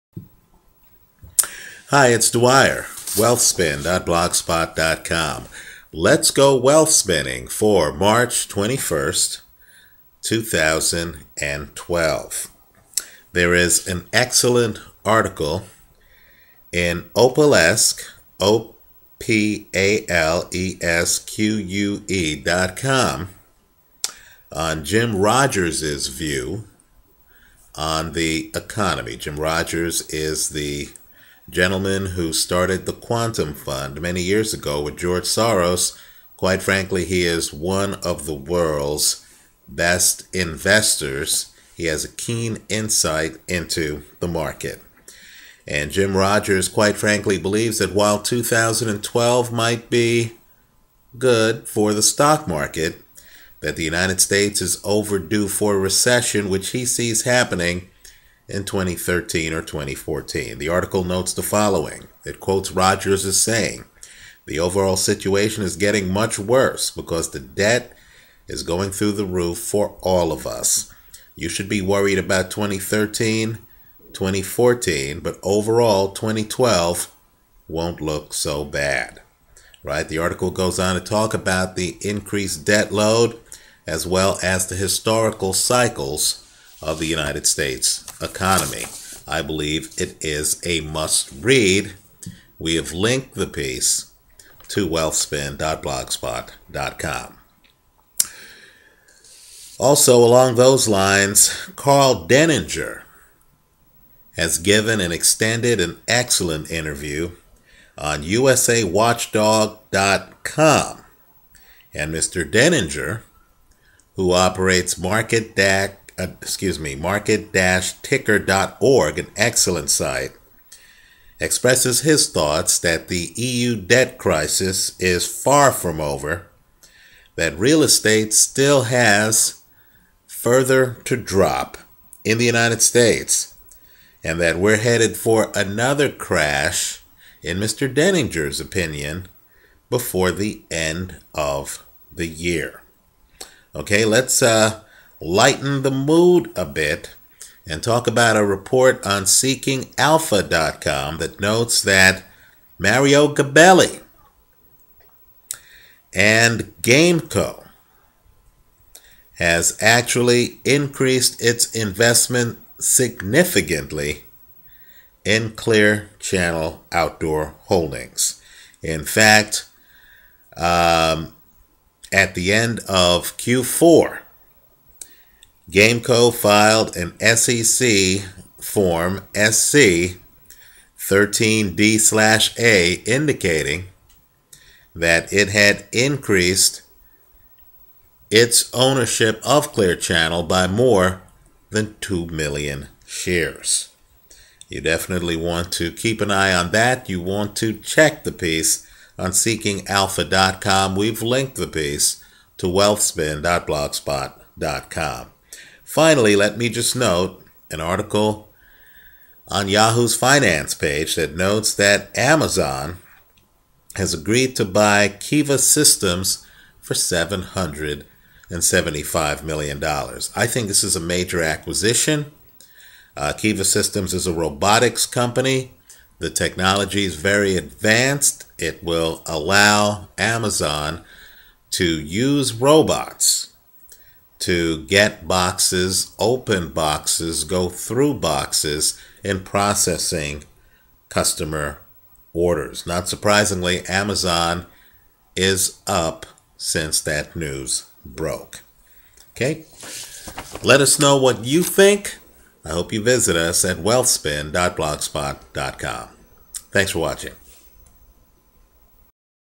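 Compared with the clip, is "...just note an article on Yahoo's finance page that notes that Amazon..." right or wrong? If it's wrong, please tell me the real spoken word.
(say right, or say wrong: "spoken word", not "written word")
right.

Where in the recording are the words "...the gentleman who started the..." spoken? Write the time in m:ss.
0:30.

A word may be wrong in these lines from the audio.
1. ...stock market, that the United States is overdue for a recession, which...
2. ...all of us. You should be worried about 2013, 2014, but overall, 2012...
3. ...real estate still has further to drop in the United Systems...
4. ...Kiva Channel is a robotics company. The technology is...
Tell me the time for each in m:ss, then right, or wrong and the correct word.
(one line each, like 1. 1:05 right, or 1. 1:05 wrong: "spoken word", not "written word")
1. 0:52 right
2. 1:10 right
3. 2:07 wrong: "States", not "Systems"
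4. 3:43 wrong: "Systems", not "Channel".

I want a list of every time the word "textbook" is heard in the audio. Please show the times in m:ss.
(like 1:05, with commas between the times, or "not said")
not said.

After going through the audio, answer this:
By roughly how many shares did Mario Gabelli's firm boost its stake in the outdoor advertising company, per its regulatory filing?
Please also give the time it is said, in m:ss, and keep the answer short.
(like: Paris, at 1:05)
more than 2 million, at 3:10.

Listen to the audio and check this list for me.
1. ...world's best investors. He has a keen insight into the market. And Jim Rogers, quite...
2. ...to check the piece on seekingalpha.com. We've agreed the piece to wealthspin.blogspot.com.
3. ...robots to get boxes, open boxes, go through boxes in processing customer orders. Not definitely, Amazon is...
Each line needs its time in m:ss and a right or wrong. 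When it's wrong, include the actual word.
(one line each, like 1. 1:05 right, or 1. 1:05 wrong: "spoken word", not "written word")
1. 0:38 right
2. 3:17 wrong: "linked", not "agreed"
3. 3:52 wrong: "surprisingly", not "definitely".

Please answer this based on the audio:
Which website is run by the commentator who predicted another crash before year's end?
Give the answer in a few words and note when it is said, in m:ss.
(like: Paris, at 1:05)
market-ticker.org, at 1:56.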